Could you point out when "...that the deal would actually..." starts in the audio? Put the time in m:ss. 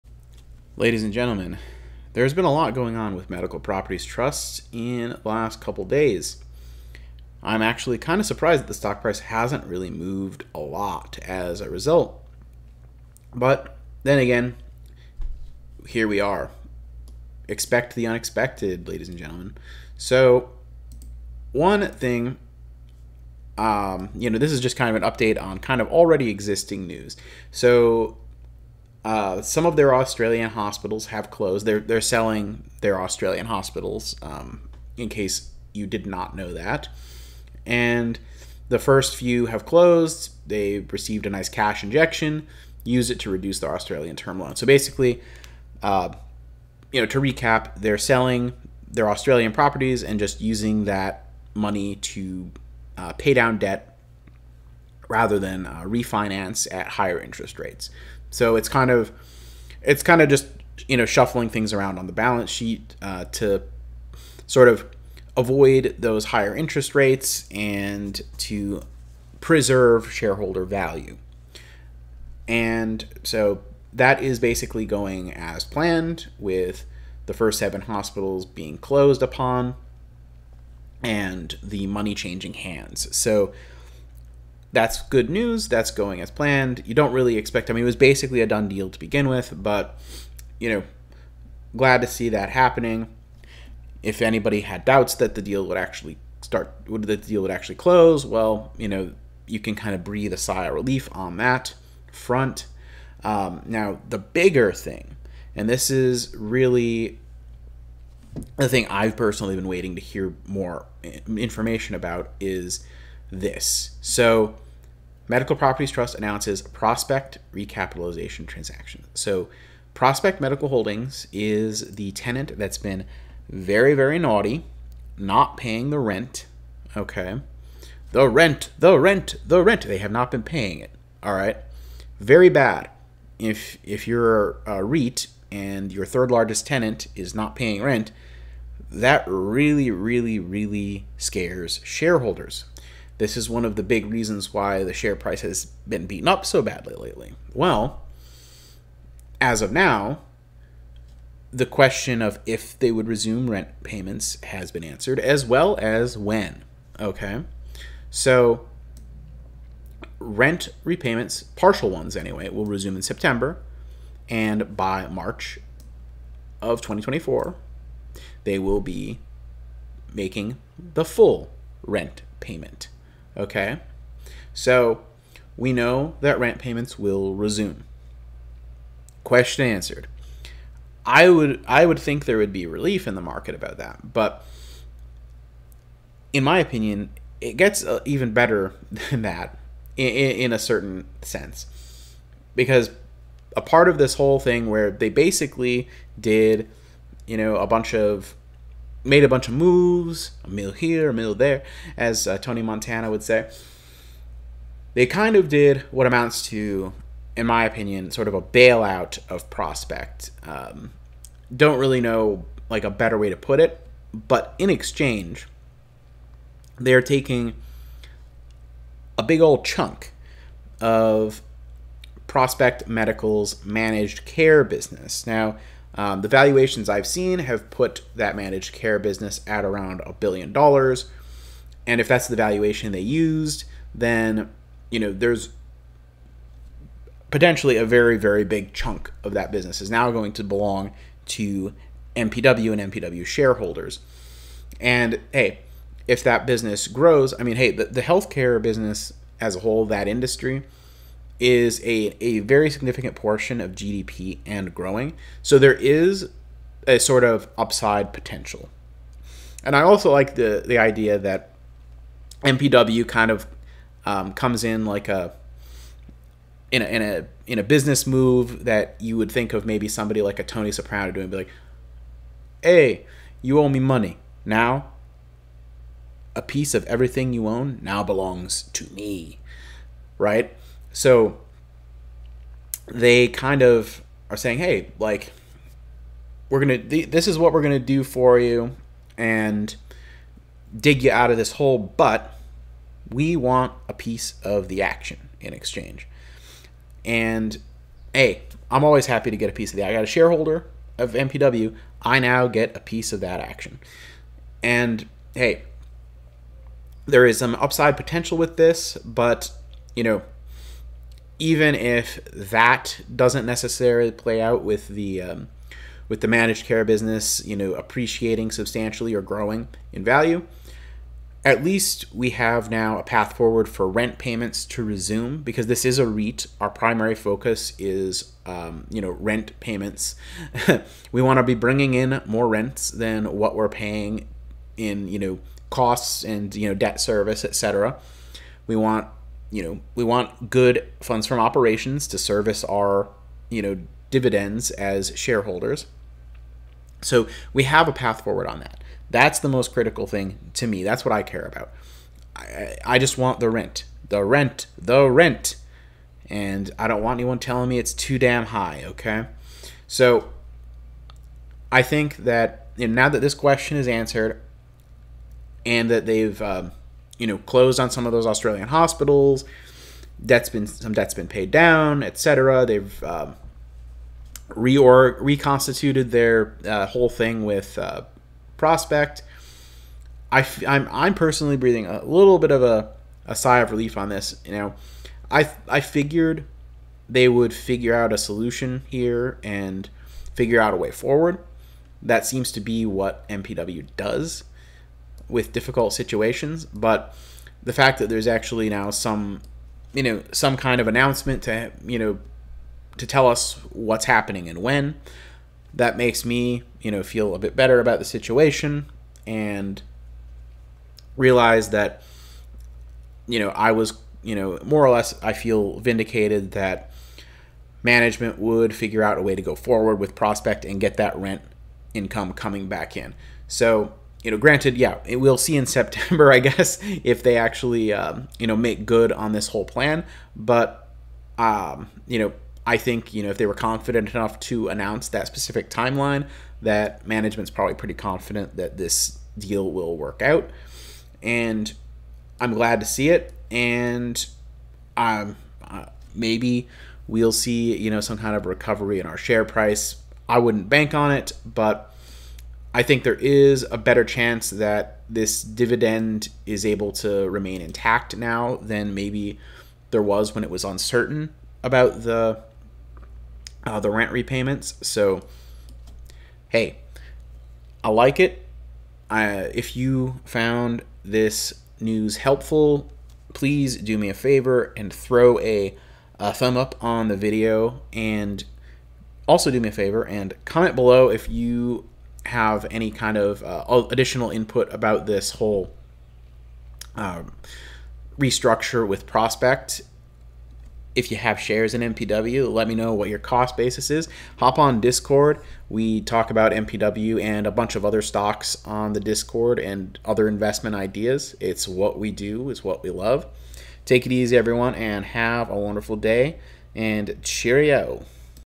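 1:35.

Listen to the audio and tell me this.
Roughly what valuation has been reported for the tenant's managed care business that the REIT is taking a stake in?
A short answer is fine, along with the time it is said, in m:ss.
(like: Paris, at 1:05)
$1 billion, at 3:50.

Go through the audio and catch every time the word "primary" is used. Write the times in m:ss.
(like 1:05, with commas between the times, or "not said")
5:26.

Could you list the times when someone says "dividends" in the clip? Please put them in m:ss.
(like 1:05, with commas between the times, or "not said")
5:44, 7:35.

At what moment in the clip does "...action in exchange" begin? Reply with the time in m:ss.
4:54.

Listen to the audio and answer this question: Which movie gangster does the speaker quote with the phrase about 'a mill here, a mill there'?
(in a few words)
Tony Montana.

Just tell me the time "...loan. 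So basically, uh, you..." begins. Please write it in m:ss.
0:44.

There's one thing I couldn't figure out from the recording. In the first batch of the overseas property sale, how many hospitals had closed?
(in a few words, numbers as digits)
7.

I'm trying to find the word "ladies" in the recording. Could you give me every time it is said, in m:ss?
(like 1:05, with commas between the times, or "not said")
0:00, 0:18.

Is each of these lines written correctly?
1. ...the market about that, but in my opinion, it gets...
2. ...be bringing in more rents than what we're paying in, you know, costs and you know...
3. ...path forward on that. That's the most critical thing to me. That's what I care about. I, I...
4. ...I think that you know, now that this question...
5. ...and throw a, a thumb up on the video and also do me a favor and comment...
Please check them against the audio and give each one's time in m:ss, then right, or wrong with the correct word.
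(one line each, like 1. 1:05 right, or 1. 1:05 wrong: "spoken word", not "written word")
1. 3:03 right
2. 5:31 right
3. 5:47 right
4. 6:01 right
5. 7:54 right.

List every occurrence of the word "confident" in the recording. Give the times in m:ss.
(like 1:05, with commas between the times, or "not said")
7:13, 7:17.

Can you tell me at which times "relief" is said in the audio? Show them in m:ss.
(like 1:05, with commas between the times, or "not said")
1:40, 3:02, 6:23.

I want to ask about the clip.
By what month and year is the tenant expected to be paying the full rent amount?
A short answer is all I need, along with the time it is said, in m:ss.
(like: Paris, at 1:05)
March 2024, at 2:45.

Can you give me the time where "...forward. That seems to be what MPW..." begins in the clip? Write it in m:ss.
6:30.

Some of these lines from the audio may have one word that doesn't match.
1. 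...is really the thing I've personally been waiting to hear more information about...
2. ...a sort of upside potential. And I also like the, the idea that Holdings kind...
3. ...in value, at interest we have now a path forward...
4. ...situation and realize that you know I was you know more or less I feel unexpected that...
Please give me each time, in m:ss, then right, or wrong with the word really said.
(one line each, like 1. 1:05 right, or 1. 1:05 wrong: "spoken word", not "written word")
1. 1:45 right
2. 4:16 wrong: "MPW", not "Holdings"
3. 5:19 wrong: "least", not "interest"
4. 6:48 wrong: "vindicated", not "unexpected".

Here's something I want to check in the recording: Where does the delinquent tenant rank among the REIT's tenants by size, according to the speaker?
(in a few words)
Third largest.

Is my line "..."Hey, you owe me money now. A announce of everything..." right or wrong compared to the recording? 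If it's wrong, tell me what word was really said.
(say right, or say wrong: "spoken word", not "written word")
wrong: "piece", not "announce".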